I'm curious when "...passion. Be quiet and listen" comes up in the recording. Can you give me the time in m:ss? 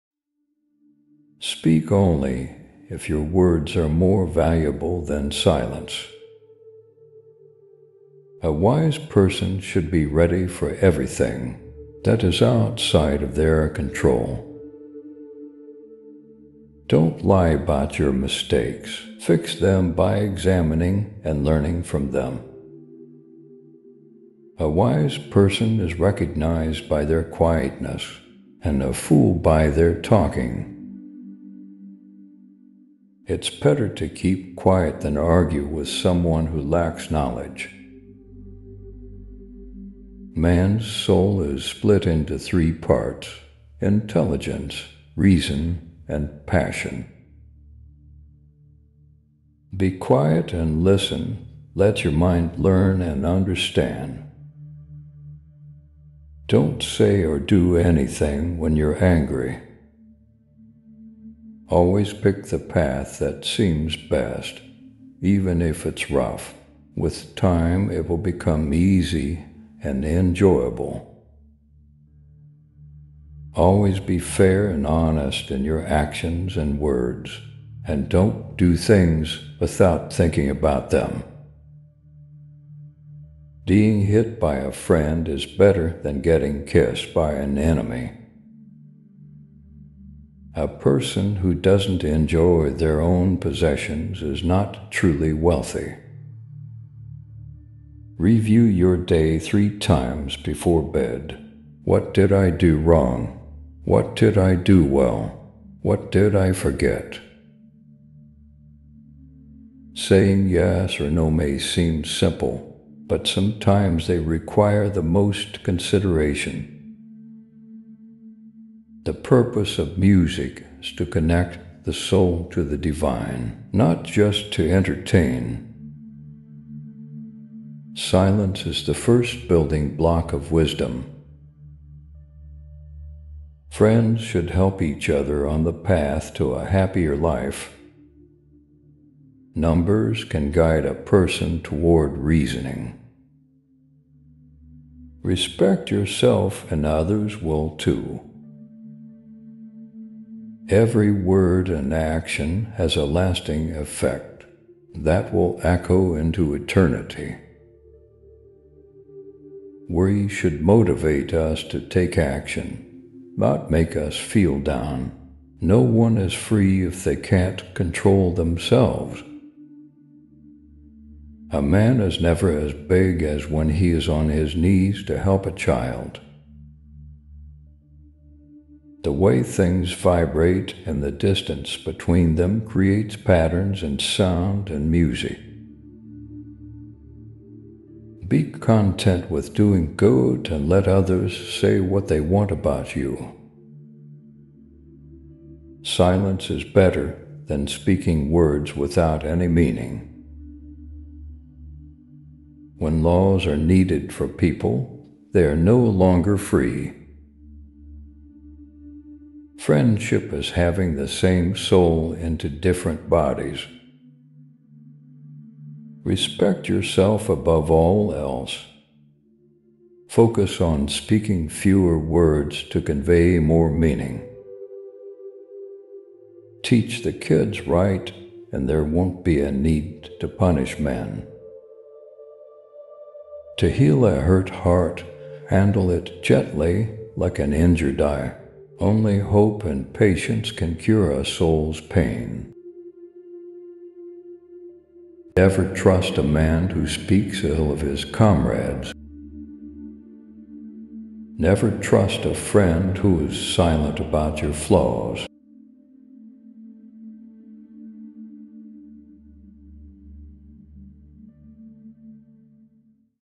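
0:46.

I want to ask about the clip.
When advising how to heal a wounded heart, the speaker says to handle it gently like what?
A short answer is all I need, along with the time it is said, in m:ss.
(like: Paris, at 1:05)
an injured eye, at 3:57.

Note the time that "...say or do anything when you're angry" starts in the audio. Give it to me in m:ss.
0:56.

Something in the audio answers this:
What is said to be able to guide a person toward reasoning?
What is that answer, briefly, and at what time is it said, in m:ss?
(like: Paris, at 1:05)
Numbers, at 2:19.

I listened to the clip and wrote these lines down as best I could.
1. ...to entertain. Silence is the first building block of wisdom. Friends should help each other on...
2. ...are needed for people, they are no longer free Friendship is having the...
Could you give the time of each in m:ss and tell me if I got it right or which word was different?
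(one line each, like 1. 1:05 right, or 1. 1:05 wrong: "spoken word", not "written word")
1. 2:04 right
2. 3:23 right.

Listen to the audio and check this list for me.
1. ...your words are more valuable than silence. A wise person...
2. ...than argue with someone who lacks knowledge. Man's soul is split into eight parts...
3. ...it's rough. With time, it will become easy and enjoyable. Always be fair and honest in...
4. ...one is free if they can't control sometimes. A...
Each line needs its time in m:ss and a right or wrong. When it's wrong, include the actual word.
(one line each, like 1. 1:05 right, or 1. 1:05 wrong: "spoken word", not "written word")
1. 0:03 right
2. 0:35 wrong: "three", not "eight"
3. 1:05 right
4. 2:45 wrong: "themselves", not "sometimes".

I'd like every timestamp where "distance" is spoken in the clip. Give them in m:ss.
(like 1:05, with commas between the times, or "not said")
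3:01.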